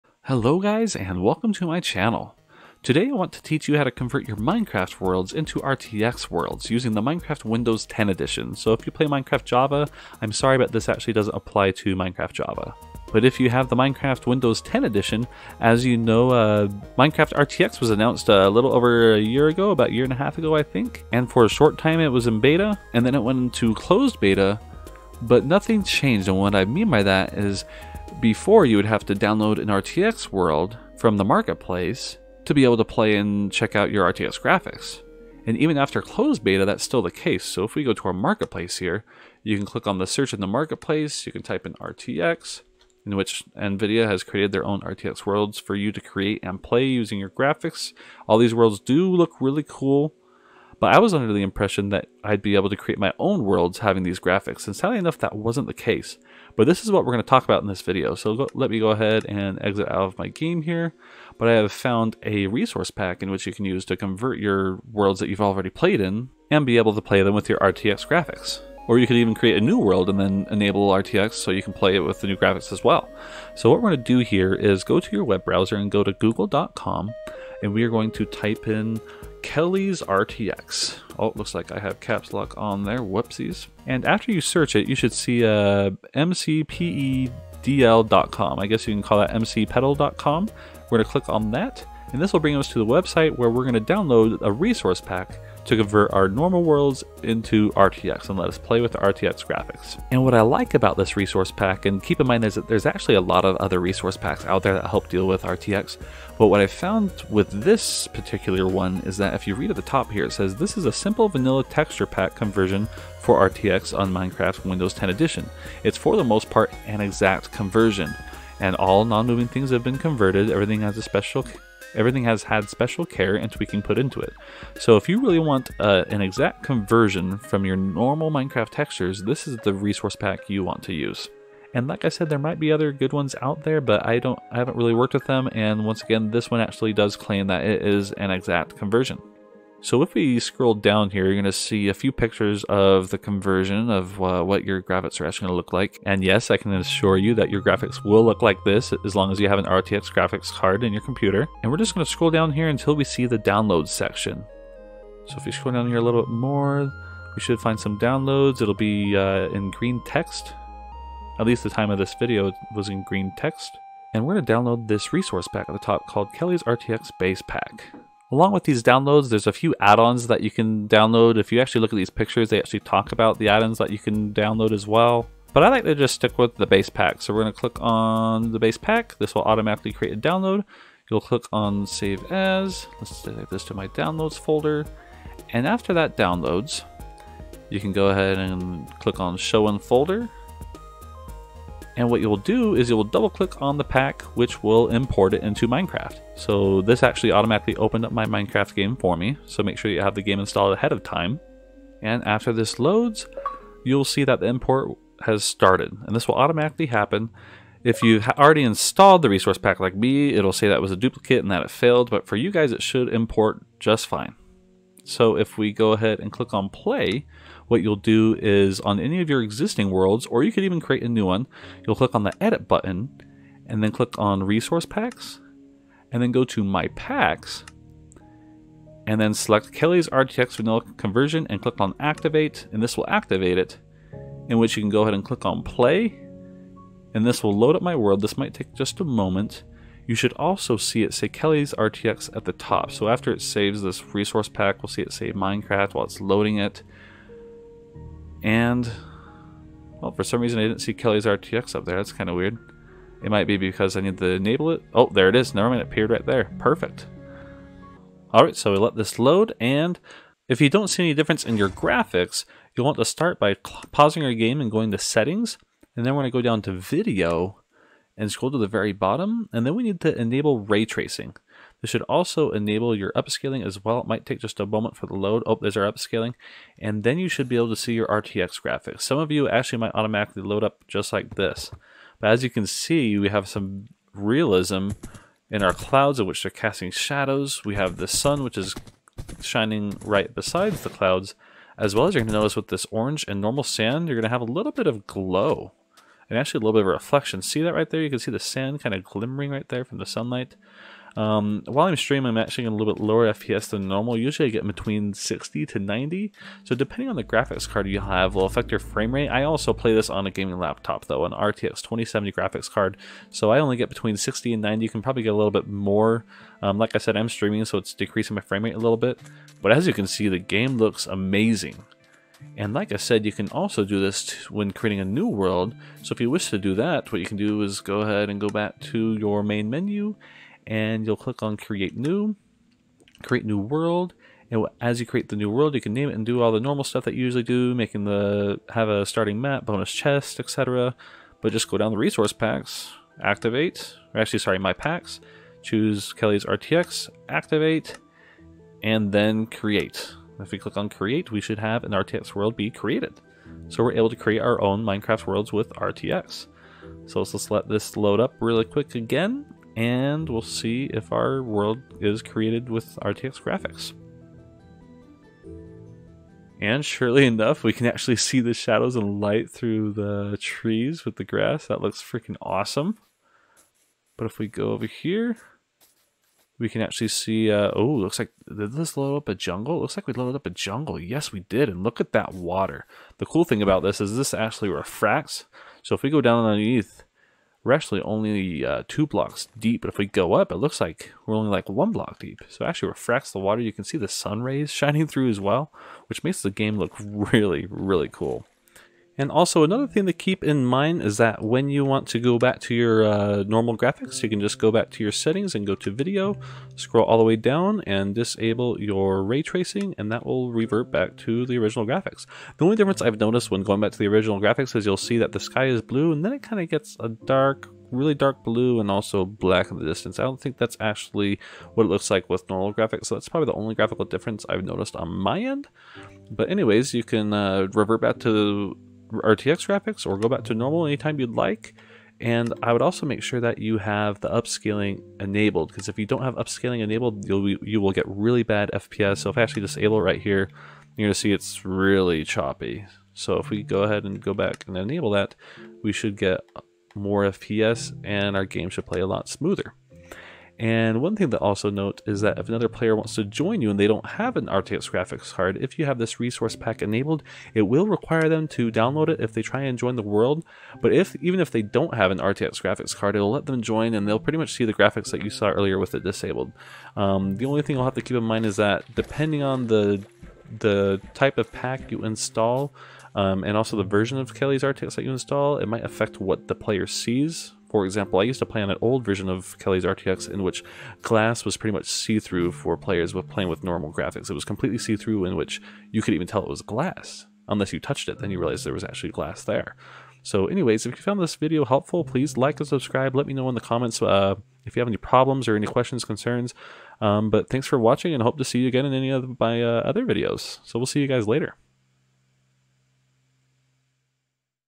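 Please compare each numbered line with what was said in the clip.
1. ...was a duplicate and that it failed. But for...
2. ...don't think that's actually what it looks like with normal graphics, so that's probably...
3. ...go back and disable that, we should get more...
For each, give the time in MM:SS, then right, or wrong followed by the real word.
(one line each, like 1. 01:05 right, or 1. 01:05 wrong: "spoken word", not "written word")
1. 03:30 right
2. 07:00 right
3. 07:24 wrong: "enable", not "disable".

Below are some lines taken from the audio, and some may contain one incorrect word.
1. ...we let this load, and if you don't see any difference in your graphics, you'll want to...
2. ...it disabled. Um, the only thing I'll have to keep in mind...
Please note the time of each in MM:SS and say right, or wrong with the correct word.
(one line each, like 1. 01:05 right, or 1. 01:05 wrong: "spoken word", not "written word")
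1. 04:18 right
2. 07:45 right.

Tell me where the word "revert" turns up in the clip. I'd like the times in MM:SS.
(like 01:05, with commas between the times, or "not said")
06:50, 07:07.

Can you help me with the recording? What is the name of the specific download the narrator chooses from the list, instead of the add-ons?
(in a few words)
Kelly's RTX Base Pack.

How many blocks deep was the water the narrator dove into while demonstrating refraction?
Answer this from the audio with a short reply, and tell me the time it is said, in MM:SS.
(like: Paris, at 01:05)
2, at 06:28.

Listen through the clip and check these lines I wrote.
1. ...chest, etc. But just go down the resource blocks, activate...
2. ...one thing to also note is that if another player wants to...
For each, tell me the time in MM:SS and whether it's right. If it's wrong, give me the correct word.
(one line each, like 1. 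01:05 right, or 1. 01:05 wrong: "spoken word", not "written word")
1. 05:39 wrong: "packs", not "blocks"
2. 07:31 right.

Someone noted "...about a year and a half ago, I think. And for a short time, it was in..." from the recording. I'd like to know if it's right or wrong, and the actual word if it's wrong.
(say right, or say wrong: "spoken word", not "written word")
right.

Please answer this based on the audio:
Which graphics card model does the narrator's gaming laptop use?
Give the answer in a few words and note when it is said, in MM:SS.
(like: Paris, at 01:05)
RTX 2070, at 05:11.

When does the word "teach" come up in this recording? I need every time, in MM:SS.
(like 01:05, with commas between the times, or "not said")
00:03.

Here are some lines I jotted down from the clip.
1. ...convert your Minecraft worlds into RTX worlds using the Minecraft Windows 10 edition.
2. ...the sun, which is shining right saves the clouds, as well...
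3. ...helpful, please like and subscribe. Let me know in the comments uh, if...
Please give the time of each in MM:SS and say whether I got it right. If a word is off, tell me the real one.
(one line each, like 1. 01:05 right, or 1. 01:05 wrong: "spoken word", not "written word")
1. 00:03 right
2. 04:47 wrong: "besides", not "saves"
3. 08:11 right.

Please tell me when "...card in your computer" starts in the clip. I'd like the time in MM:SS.
02:30.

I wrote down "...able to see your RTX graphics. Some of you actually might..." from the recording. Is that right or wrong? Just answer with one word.
right.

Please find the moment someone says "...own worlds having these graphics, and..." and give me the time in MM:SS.
00:53.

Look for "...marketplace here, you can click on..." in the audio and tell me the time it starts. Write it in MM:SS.
00:38.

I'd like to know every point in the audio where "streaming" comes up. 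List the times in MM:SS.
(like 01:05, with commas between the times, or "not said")
05:01, 05:17.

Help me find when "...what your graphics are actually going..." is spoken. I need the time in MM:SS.
02:24.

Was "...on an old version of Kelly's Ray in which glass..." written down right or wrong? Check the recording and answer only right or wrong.
wrong.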